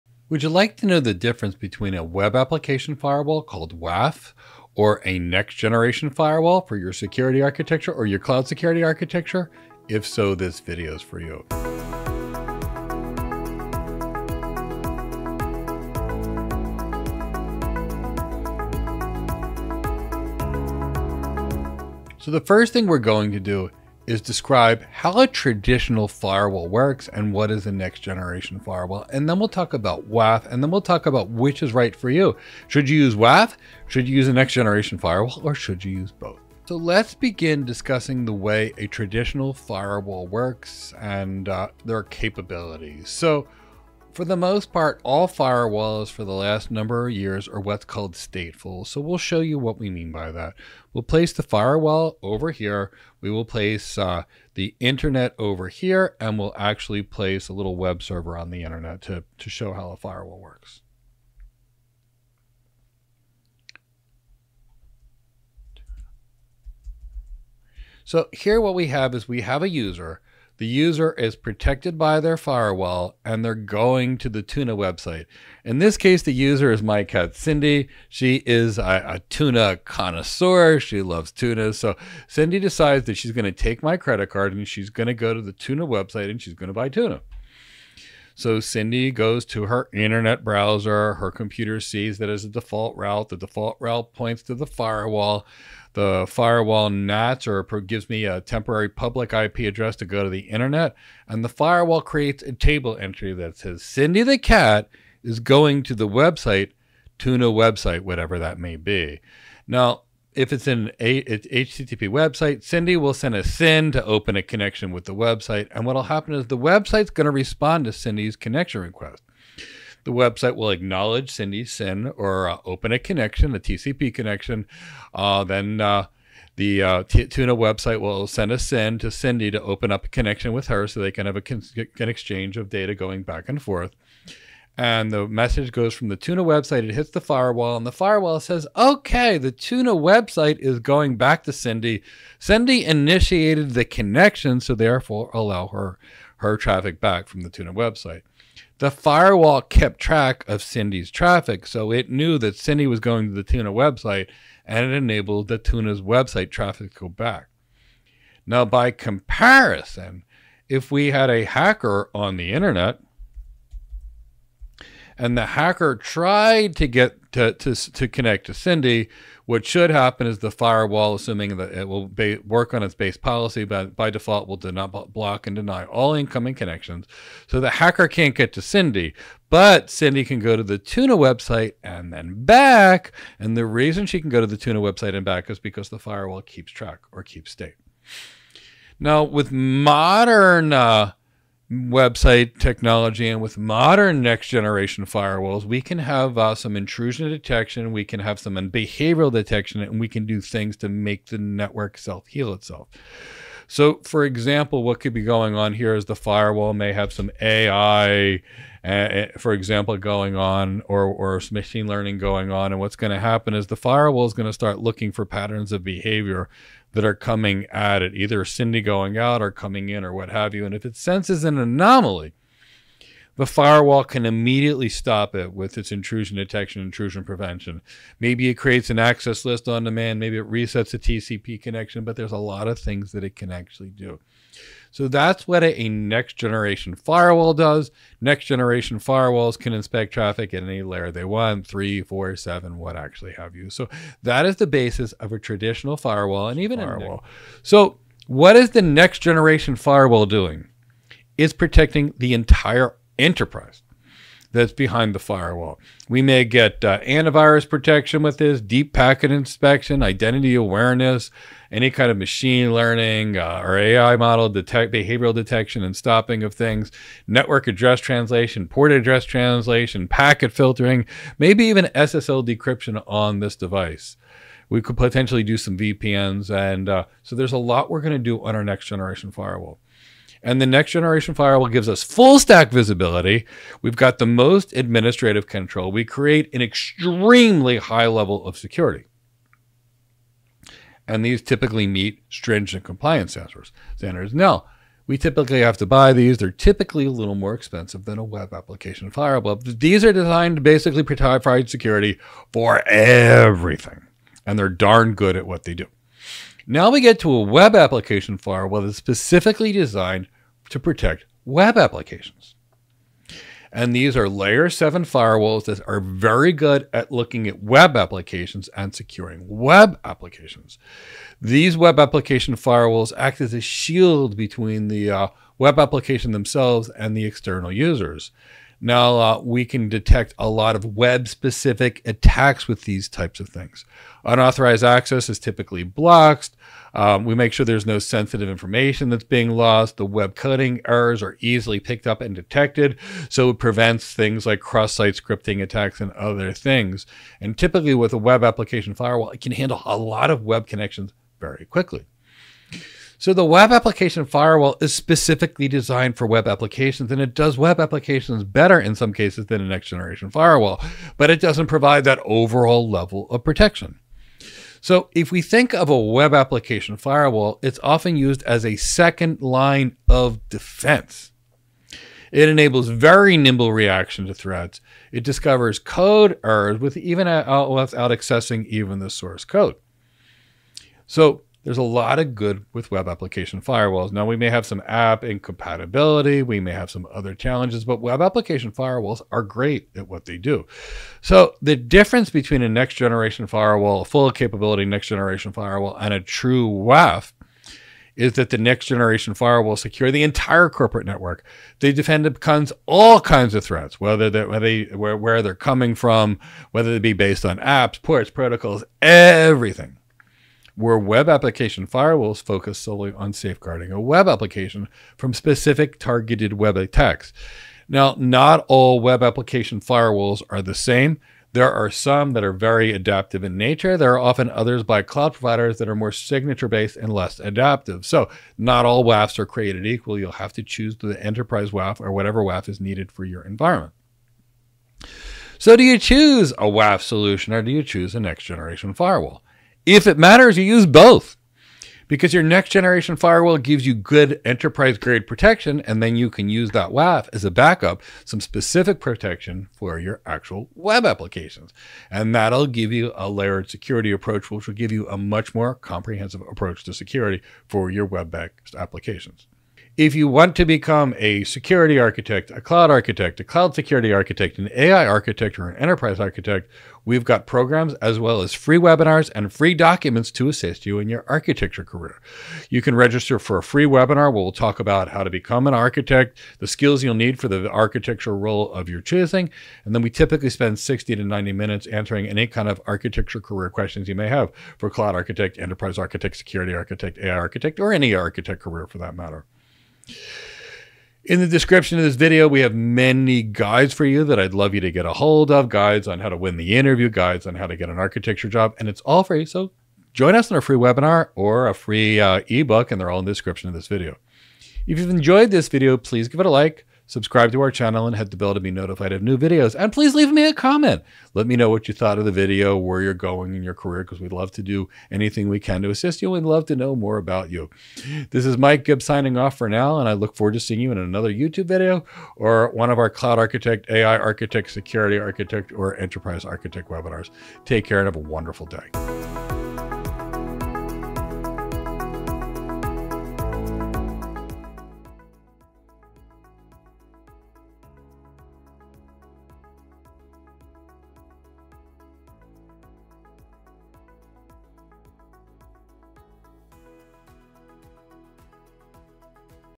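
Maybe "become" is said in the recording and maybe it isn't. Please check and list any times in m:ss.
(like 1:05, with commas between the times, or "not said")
7:40, 7:55.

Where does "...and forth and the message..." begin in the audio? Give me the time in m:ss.
2:13.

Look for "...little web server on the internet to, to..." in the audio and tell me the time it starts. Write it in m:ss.
0:57.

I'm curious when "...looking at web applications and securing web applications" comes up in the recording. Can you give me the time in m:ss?
5:17.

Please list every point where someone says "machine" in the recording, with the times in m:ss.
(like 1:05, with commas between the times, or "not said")
3:31, 4:22.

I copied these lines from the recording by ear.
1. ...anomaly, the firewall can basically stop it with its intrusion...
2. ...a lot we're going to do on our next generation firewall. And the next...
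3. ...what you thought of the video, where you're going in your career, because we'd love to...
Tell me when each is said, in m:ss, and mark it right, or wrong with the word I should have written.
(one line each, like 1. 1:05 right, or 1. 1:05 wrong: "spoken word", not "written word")
1. 3:41 wrong: "immediately", not "basically"
2. 4:37 right
3. 8:31 right.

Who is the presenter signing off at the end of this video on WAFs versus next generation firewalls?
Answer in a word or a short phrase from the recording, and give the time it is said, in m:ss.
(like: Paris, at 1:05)
Mike Gibbs, at 8:38.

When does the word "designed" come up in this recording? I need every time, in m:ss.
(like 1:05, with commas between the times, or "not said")
5:00, 5:09, 5:55.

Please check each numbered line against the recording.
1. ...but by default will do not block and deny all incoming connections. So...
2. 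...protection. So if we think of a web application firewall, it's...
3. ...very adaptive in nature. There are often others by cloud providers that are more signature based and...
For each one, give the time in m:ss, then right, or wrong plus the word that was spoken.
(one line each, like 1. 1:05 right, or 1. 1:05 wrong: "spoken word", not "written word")
1. 2:53 right
2. 6:03 right
3. 7:02 right.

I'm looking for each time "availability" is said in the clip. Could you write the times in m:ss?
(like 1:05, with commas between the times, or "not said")
not said.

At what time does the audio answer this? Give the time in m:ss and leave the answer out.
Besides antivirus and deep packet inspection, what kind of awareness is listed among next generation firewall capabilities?
4:20.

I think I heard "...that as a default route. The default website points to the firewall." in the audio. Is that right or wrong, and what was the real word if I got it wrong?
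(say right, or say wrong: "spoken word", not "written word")
wrong: "route", not "website".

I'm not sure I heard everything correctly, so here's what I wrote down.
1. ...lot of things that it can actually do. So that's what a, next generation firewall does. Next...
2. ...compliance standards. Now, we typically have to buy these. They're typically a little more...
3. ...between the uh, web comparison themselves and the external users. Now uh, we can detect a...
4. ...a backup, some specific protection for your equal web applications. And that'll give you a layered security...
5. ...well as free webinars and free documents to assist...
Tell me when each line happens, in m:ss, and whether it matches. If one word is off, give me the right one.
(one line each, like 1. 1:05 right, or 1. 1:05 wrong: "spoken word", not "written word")
1. 3:52 right
2. 4:52 right
3. 5:24 wrong: "application", not "comparison"
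4. 7:27 wrong: "actual", not "equal"
5. 7:48 right.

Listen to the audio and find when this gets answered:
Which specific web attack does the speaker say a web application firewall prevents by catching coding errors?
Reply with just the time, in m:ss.
5:44.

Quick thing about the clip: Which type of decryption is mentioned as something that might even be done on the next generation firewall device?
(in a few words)
SSL decryption.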